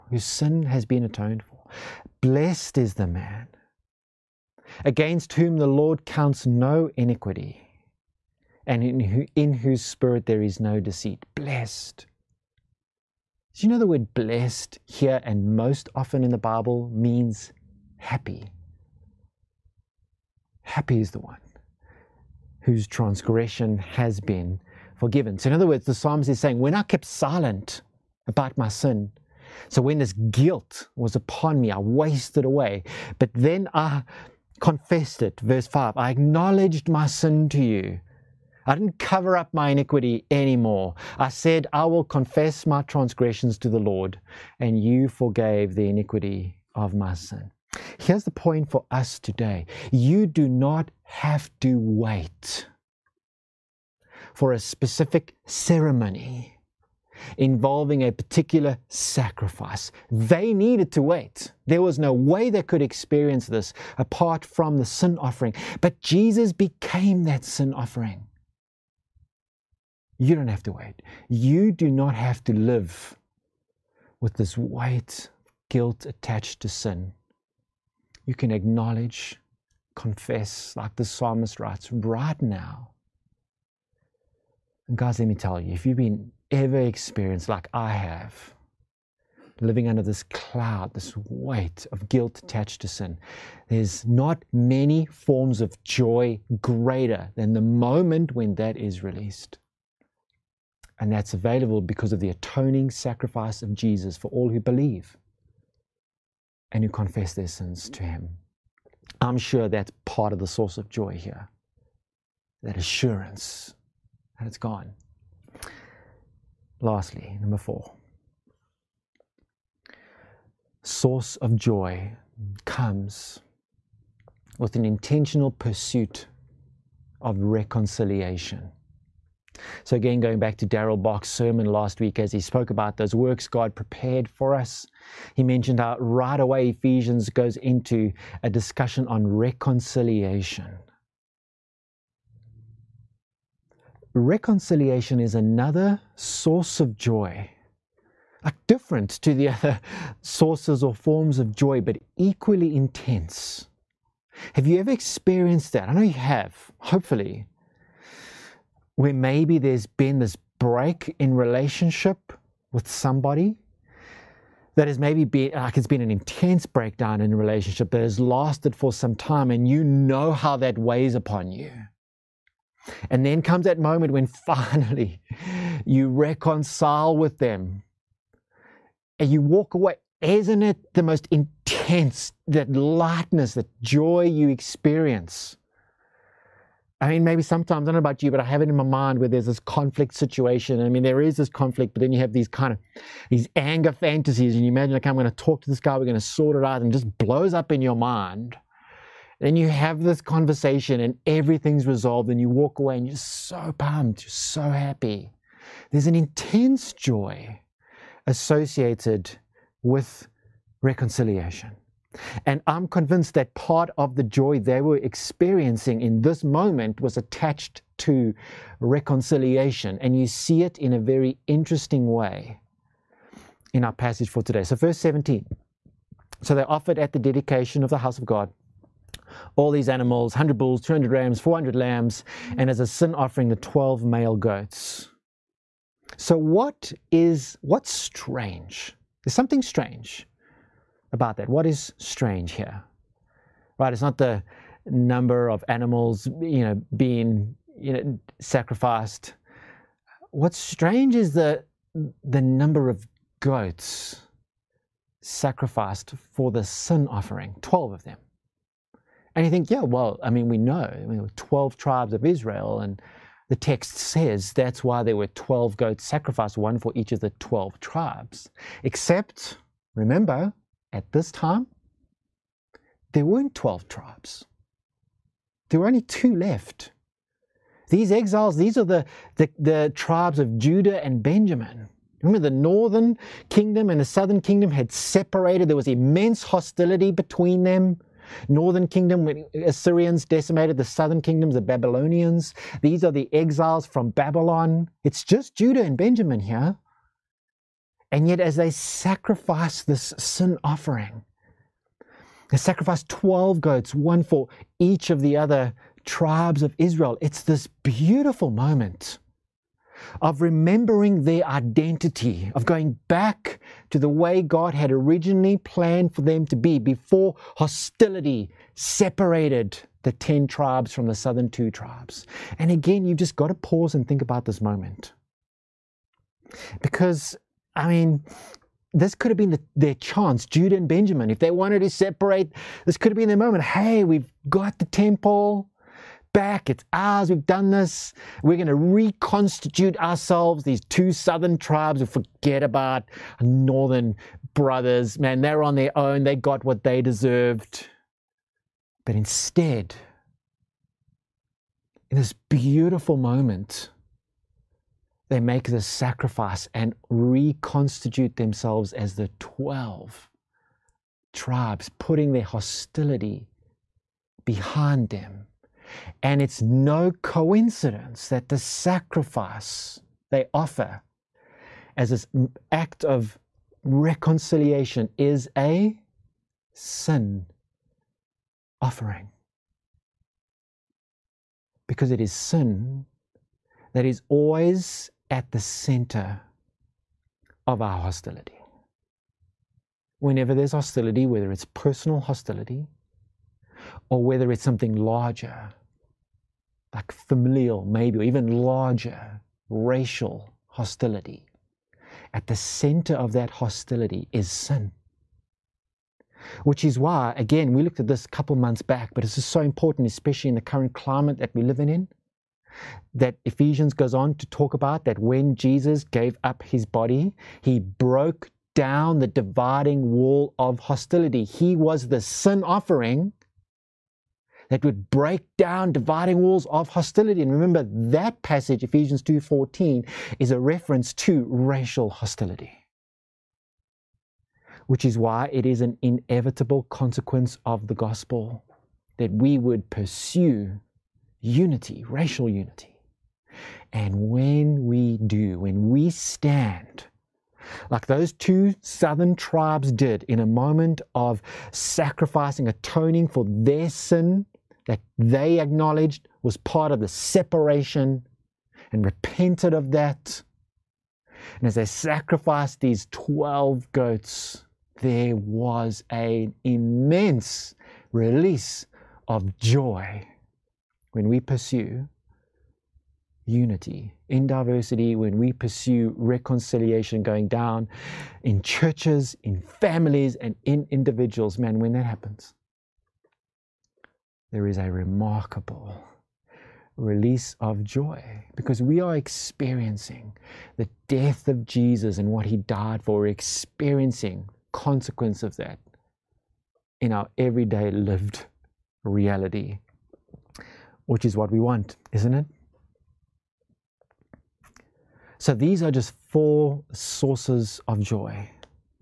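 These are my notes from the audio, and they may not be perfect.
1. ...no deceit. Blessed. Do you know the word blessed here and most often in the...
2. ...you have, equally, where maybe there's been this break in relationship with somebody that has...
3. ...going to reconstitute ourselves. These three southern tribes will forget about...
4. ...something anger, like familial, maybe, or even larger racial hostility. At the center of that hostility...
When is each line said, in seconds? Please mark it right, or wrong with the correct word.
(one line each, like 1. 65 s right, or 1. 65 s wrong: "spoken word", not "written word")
1. 10 s right
2. 156 s wrong: "hopefully", not "equally"
3. 338 s wrong: "two", not "three"
4. 394 s wrong: "larger", not "anger".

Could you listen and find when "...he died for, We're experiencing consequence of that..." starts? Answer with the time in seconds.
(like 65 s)
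492 s.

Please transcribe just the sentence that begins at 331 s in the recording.
If they wanted to separate, this could have been their moment.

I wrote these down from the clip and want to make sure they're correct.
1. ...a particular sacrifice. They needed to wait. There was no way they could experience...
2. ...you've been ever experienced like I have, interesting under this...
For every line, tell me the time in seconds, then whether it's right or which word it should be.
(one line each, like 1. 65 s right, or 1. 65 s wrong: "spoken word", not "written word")
1. 58 s right
2. 85 s wrong: "living", not "interesting".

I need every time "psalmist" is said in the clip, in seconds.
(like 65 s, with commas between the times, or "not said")
25 s, 81 s.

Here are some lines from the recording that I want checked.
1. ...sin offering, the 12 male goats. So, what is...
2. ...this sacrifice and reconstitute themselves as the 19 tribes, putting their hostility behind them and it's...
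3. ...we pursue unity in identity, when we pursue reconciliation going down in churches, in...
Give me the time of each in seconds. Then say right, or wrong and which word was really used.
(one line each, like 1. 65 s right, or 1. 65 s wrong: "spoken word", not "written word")
1. 232 s right
2. 355 s wrong: "12", not "19"
3. 471 s wrong: "diversity", not "identity".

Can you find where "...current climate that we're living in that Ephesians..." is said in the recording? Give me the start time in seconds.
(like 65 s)
410 s.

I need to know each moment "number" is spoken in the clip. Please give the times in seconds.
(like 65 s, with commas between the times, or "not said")
117 s, 244 s, 252 s.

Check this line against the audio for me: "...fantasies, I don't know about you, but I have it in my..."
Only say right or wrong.
wrong.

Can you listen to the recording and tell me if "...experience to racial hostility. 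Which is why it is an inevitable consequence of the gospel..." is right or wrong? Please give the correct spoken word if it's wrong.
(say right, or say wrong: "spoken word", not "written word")
wrong: "reference", not "experience".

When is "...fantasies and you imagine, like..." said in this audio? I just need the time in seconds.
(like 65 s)
193 s.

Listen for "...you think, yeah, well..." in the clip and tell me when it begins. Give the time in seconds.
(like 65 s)
259 s.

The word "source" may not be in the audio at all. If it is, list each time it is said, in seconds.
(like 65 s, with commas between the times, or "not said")
110 s, 120 s, 146 s, 150 s, 506 s.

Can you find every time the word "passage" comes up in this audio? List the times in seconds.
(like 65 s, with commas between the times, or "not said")
223 s, 428 s.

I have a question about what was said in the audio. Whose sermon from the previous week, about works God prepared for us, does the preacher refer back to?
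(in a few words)
Daryl Bach.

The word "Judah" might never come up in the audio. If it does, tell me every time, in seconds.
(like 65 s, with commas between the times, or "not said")
280 s, 295 s, 330 s.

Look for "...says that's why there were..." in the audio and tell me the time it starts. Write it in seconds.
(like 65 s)
263 s.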